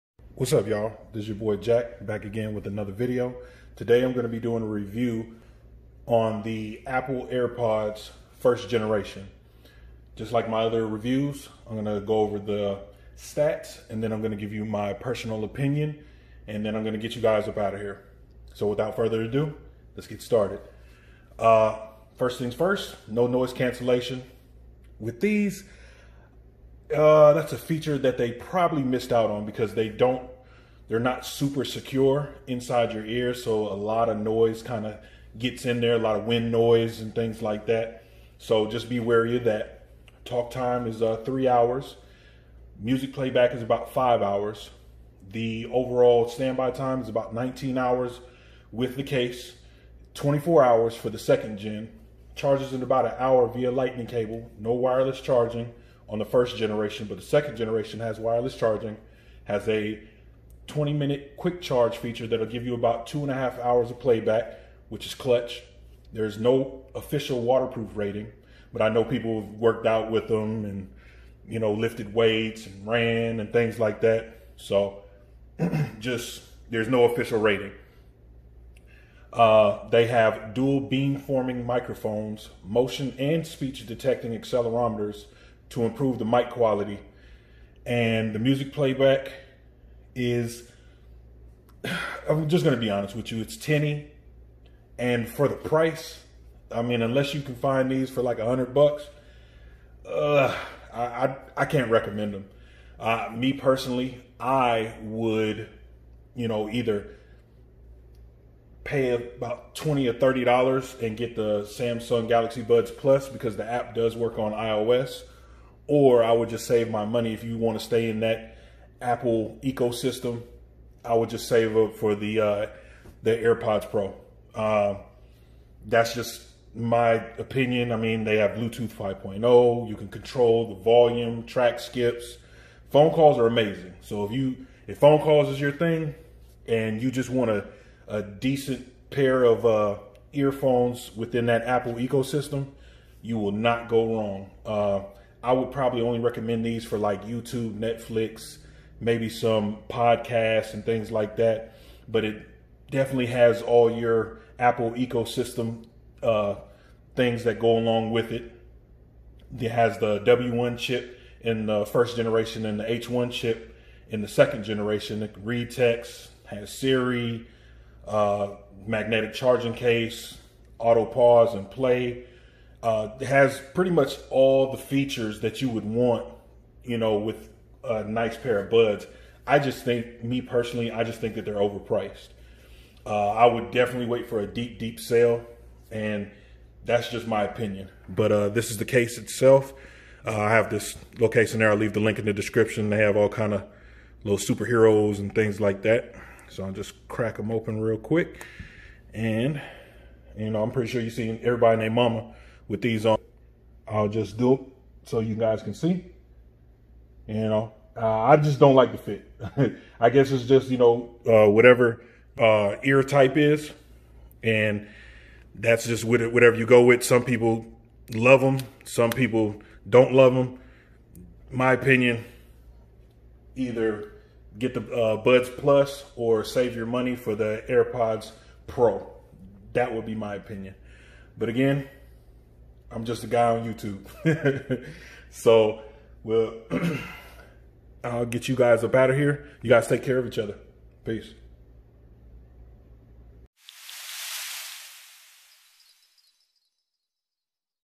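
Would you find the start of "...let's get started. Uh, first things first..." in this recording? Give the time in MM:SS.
00:19.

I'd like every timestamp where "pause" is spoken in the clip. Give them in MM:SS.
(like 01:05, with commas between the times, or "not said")
02:51.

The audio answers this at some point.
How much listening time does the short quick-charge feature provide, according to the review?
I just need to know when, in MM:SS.
01:03.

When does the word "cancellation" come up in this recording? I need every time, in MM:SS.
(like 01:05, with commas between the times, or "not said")
00:23.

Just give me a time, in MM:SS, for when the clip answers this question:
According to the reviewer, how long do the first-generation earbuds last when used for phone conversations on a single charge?
00:41.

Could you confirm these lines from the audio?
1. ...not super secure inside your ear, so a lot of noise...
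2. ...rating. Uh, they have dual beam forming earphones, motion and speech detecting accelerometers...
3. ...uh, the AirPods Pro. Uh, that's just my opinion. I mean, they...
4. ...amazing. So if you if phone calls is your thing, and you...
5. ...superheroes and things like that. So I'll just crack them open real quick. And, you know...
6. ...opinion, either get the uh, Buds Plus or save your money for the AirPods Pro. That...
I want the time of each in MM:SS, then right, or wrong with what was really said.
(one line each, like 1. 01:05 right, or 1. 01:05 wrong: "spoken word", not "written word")
1. 00:30 right
2. 01:17 wrong: "microphones", not "earphones"
3. 02:02 right
4. 02:13 right
5. 03:14 right
6. 03:41 right.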